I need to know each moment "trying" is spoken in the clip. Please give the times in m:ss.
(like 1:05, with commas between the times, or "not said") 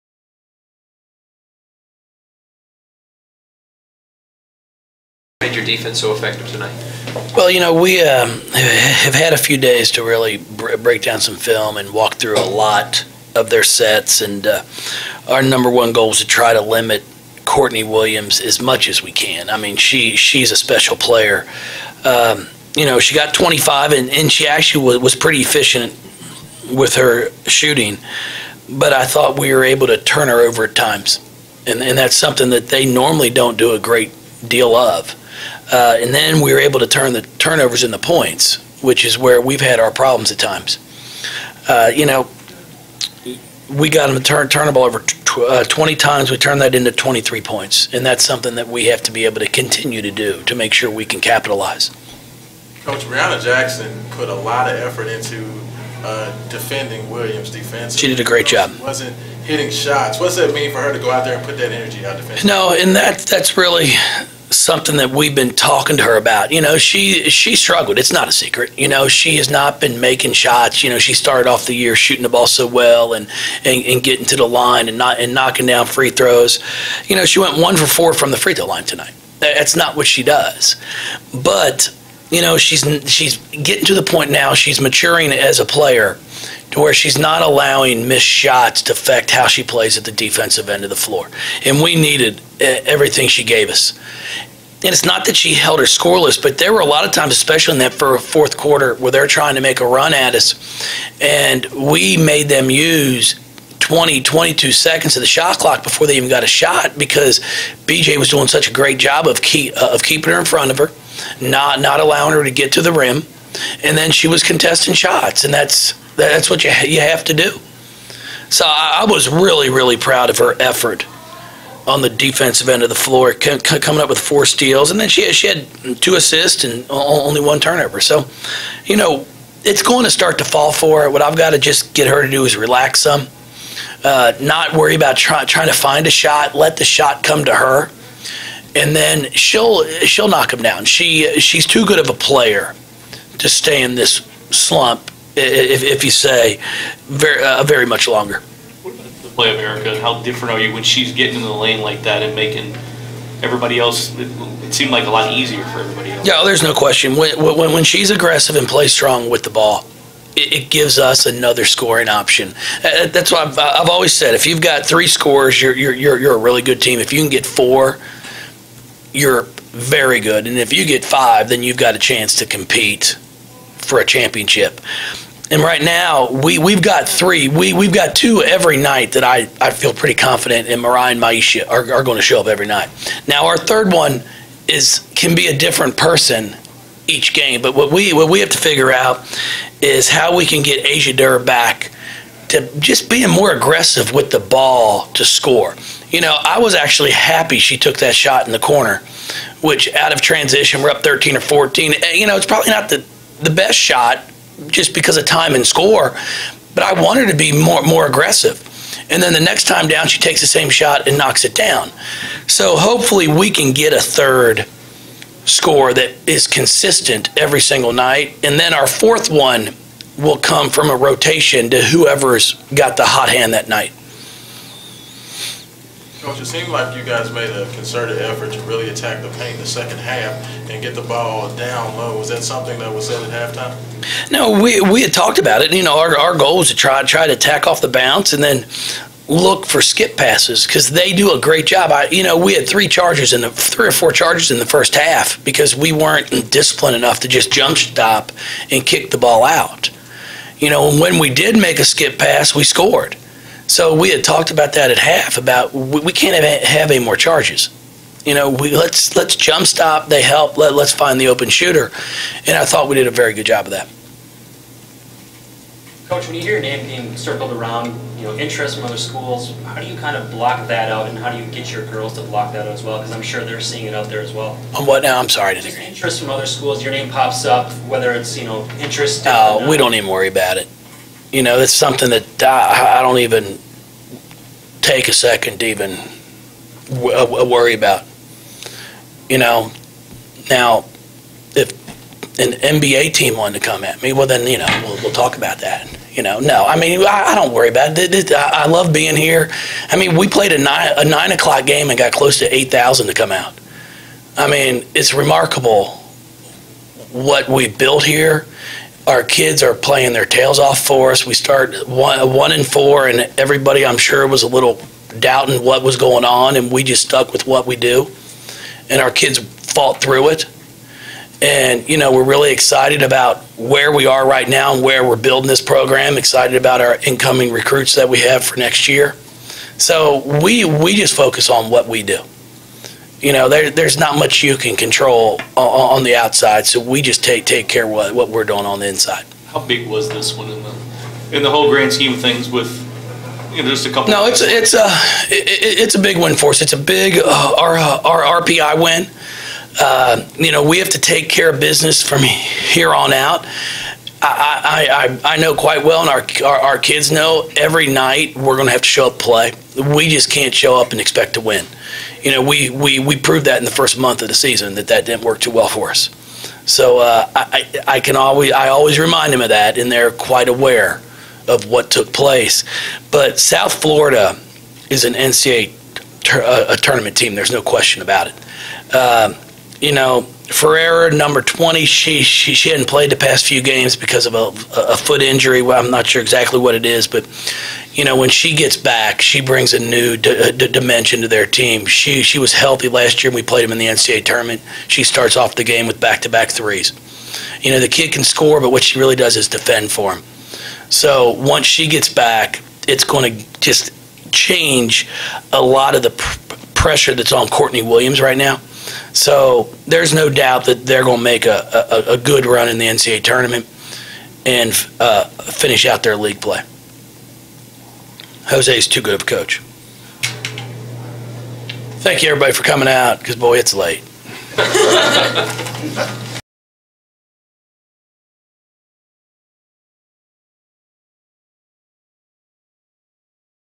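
1:39, 2:15.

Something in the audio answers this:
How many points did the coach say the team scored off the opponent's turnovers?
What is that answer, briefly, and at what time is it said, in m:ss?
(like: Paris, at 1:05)
23, at 0:46.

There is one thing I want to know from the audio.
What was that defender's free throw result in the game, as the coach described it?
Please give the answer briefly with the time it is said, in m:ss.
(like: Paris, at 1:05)
1 for 4, at 1:17.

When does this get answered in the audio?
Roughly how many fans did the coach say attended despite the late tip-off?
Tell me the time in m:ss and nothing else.
5:02.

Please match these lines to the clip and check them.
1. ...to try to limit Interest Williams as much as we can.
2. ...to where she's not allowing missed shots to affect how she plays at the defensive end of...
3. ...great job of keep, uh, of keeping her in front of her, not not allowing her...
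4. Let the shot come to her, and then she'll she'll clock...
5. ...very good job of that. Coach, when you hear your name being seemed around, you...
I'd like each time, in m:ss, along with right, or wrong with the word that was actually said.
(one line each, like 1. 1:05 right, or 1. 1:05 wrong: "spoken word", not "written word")
1. 0:16 wrong: "Courtney", not "Interest"
2. 1:26 right
3. 1:48 right
4. 2:16 wrong: "knock", not "clock"
5. 4:23 wrong: "circled", not "seemed".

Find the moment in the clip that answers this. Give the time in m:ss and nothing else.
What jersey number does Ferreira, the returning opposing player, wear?
6:21.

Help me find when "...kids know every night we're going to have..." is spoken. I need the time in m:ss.
5:56.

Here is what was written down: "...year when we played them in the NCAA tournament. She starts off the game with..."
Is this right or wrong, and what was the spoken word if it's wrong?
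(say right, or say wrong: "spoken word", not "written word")
right.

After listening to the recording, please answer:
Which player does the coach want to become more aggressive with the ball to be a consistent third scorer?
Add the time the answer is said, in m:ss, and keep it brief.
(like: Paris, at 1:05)
Asia Durr, at 3:10.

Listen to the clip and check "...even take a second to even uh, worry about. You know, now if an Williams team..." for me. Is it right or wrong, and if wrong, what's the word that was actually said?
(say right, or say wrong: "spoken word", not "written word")
wrong: "NBA", not "Williams".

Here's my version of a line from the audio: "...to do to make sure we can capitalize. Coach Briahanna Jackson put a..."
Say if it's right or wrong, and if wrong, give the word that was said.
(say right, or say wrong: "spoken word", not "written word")
right.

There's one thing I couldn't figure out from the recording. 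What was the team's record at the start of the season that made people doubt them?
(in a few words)
1-4.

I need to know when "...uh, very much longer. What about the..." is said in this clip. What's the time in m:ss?
2:27.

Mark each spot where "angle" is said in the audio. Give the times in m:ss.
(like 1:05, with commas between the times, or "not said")
not said.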